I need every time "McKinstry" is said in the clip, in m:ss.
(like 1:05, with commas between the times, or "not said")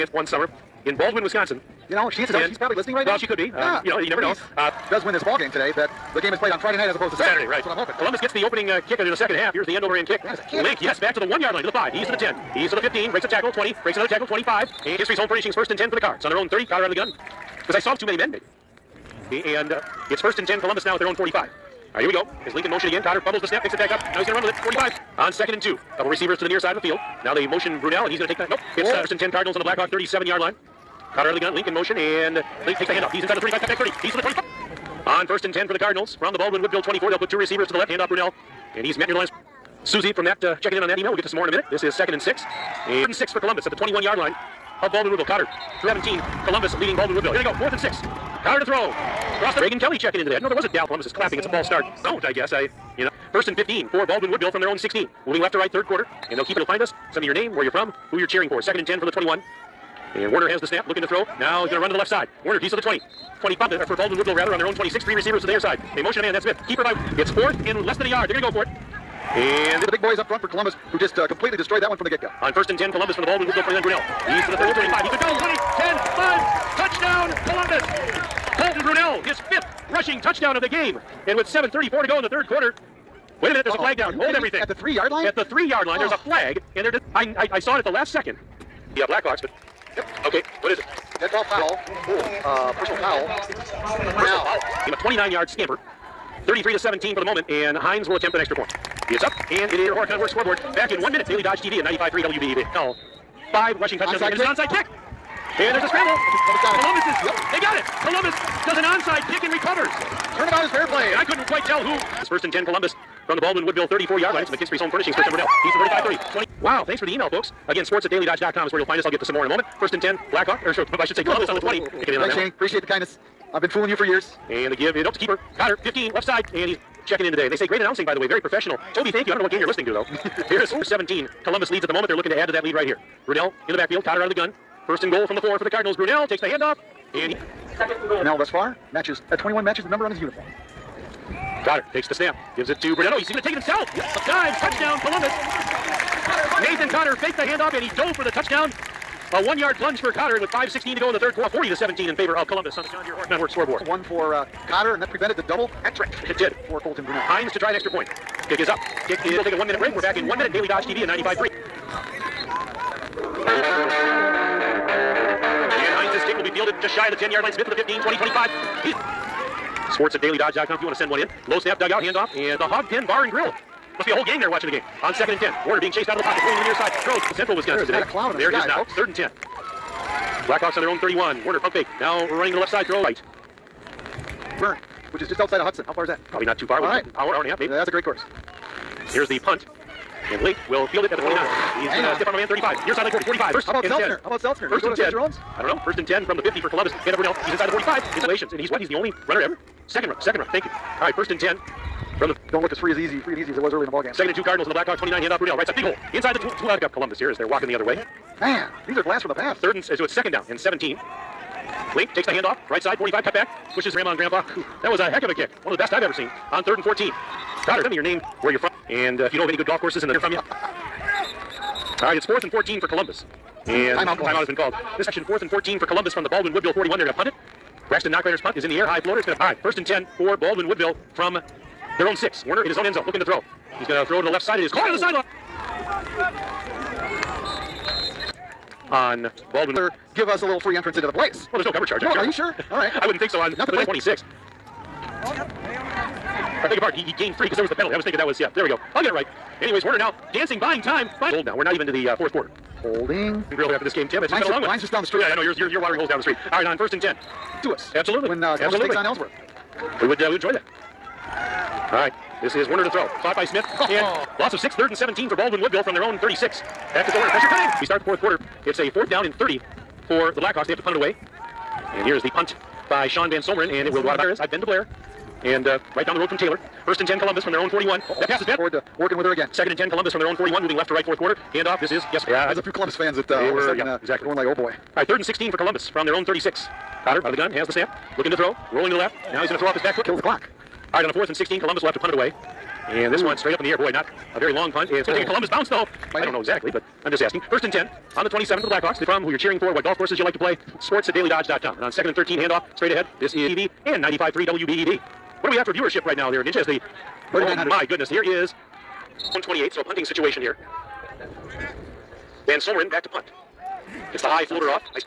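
0:14, 1:54.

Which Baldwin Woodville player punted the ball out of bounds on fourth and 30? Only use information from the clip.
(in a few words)
Sean Van Someren.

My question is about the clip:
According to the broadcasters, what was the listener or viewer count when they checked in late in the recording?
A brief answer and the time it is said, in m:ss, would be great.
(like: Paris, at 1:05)
3900, at 5:07.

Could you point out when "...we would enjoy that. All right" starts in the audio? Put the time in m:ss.
4:20.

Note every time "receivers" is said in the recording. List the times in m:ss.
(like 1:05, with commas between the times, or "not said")
0:26, 0:37, 1:05.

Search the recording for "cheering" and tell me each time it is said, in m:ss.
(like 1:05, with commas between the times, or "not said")
0:58, 4:59.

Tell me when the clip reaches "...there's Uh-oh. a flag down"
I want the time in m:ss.
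1:23.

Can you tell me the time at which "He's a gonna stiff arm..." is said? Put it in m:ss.
3:11.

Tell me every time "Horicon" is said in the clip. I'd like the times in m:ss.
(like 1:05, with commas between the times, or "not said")
1:39, 2:33.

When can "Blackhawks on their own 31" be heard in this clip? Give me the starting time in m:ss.
3:00.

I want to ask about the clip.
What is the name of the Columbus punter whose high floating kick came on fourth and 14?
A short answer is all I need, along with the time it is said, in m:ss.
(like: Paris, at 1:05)
Braxton Knockrader, at 3:47.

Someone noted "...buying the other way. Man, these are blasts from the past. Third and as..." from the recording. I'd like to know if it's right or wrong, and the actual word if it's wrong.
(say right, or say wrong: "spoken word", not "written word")
wrong: "walking", not "buying".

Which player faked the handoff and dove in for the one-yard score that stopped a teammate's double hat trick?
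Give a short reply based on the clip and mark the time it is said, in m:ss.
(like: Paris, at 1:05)
Nathan Cotter, at 2:26.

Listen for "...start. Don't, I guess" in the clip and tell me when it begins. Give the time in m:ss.
0:51.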